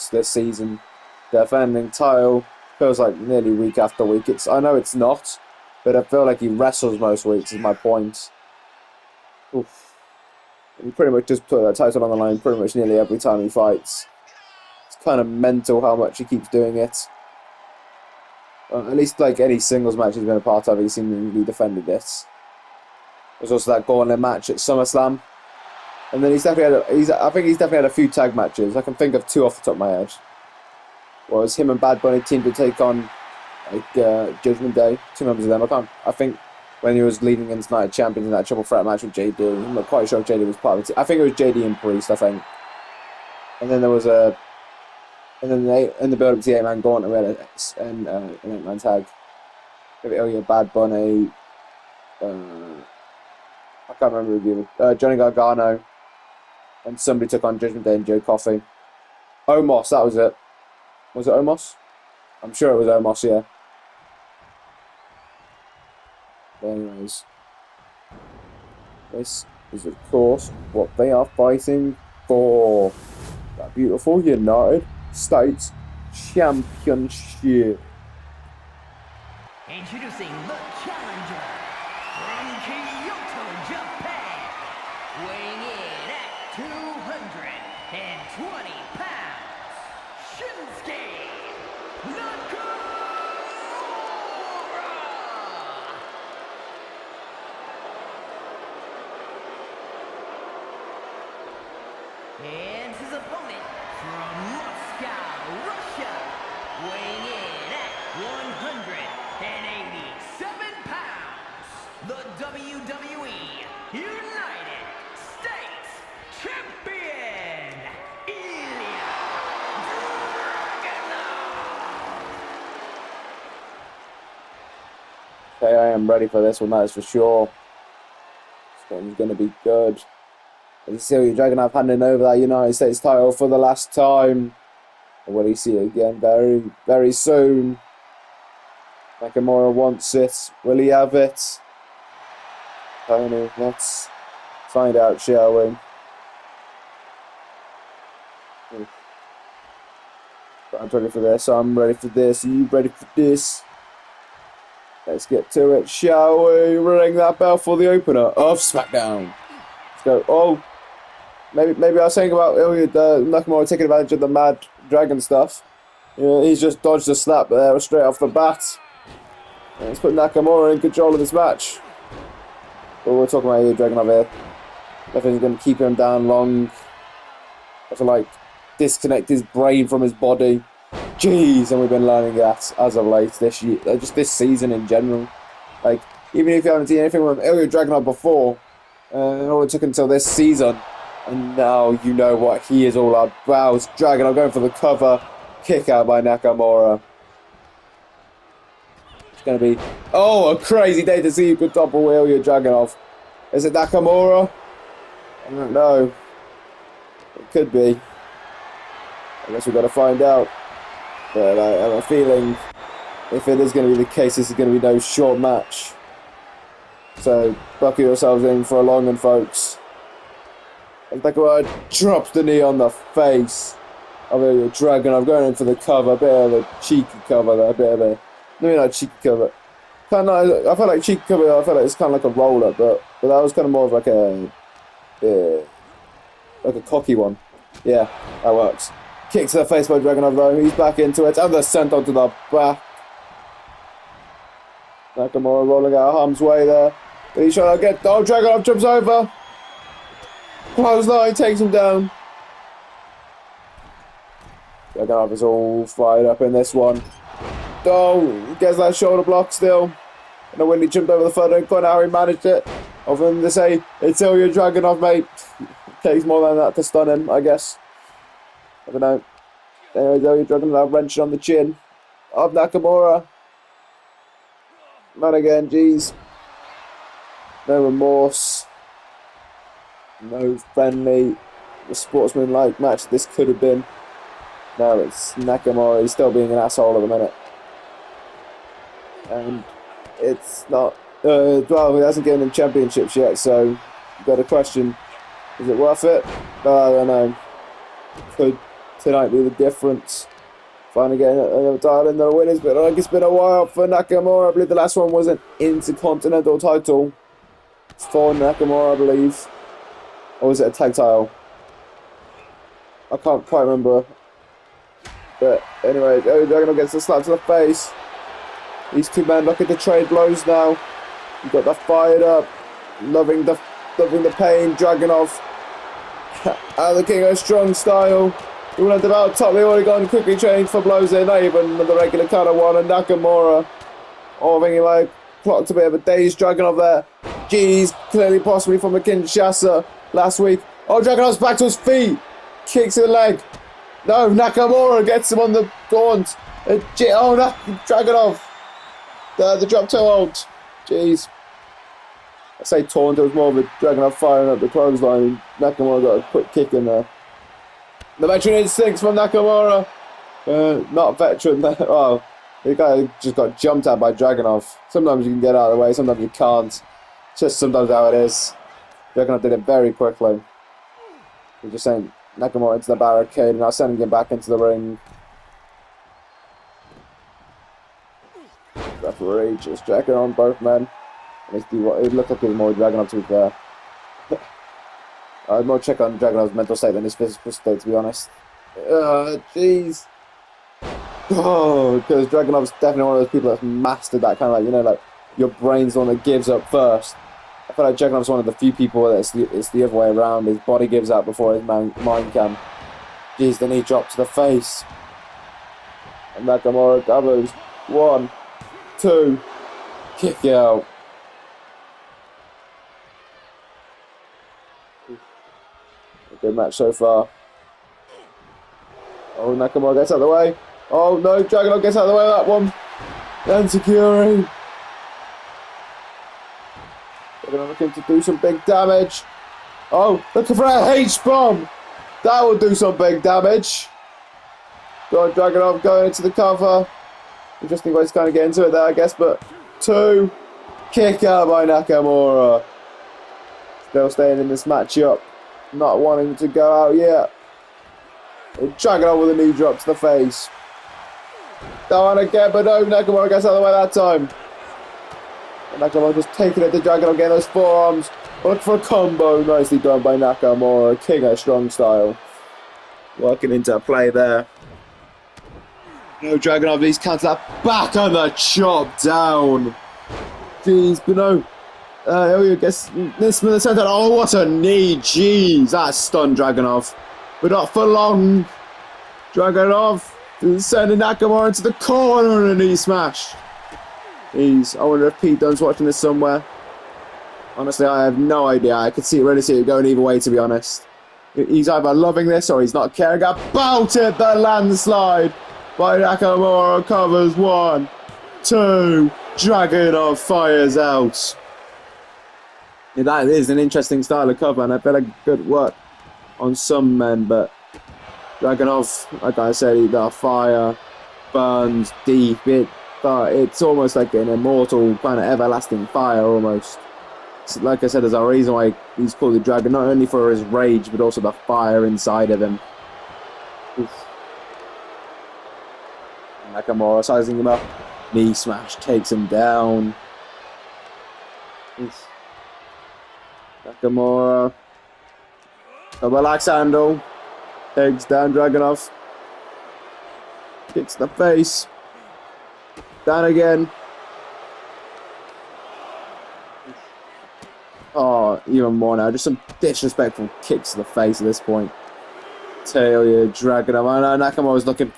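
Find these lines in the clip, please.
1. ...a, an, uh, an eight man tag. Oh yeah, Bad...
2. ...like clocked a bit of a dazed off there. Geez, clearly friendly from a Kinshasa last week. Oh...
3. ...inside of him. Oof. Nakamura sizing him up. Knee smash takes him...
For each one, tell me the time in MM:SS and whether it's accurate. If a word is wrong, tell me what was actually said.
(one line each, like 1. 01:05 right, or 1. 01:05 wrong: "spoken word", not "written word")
1. 00:48 right
2. 05:34 wrong: "possibly", not "friendly"
3. 08:41 right.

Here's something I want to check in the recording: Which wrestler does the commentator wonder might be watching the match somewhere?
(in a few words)
Pete Dunne.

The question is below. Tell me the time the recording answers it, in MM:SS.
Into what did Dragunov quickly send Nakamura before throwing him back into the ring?
06:12.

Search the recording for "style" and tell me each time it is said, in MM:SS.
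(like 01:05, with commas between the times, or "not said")
05:27, 07:41, 08:24.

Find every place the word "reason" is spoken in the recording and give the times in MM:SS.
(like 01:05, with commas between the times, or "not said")
08:38.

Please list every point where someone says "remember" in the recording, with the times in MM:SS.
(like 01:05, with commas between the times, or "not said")
00:54, 05:13.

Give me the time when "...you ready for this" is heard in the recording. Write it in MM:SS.
02:32.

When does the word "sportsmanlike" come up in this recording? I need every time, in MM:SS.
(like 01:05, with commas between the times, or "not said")
04:41.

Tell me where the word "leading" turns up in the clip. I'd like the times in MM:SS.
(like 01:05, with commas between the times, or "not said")
00:37.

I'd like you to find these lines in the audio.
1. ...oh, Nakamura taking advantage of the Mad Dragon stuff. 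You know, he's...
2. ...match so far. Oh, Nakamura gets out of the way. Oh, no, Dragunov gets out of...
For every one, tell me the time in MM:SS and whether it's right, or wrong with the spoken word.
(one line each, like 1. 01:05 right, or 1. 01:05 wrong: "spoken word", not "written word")
1. 02:42 right
2. 06:56 right.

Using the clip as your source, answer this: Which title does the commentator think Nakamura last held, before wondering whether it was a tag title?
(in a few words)
Intercontinental title.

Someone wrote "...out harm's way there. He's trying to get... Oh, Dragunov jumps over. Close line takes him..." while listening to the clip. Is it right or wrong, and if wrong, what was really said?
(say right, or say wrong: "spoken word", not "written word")
right.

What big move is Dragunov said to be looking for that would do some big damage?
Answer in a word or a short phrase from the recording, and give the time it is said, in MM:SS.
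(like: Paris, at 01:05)
H-bomb, at 07:10.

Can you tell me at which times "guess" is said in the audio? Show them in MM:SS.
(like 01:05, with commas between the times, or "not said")
03:29, 04:27, 07:18, 07:52.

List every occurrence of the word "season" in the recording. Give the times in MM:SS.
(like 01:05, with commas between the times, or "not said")
00:00, 03:04, 03:10.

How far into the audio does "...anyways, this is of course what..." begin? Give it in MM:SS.
01:06.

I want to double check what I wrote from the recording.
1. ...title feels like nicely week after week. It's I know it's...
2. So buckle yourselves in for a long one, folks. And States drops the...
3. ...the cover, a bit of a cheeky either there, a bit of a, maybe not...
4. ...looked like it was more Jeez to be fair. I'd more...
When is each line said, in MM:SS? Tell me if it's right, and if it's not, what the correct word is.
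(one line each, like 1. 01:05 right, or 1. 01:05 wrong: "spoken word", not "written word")
1. 00:01 wrong: "nearly", not "nicely"
2. 03:37 wrong: "Bekawa", not "States"
3. 03:45 wrong: "cover", not "either"
4. 06:22 wrong: "Dragunov", not "Jeez".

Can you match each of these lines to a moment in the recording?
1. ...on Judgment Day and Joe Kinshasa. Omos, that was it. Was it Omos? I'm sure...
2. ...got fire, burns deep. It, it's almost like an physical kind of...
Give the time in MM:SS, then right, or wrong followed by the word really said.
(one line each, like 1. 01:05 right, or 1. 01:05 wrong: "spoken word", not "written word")
1. 00:57 wrong: "Coffey", not "Kinshasa"
2. 08:29 wrong: "immortal", not "physical".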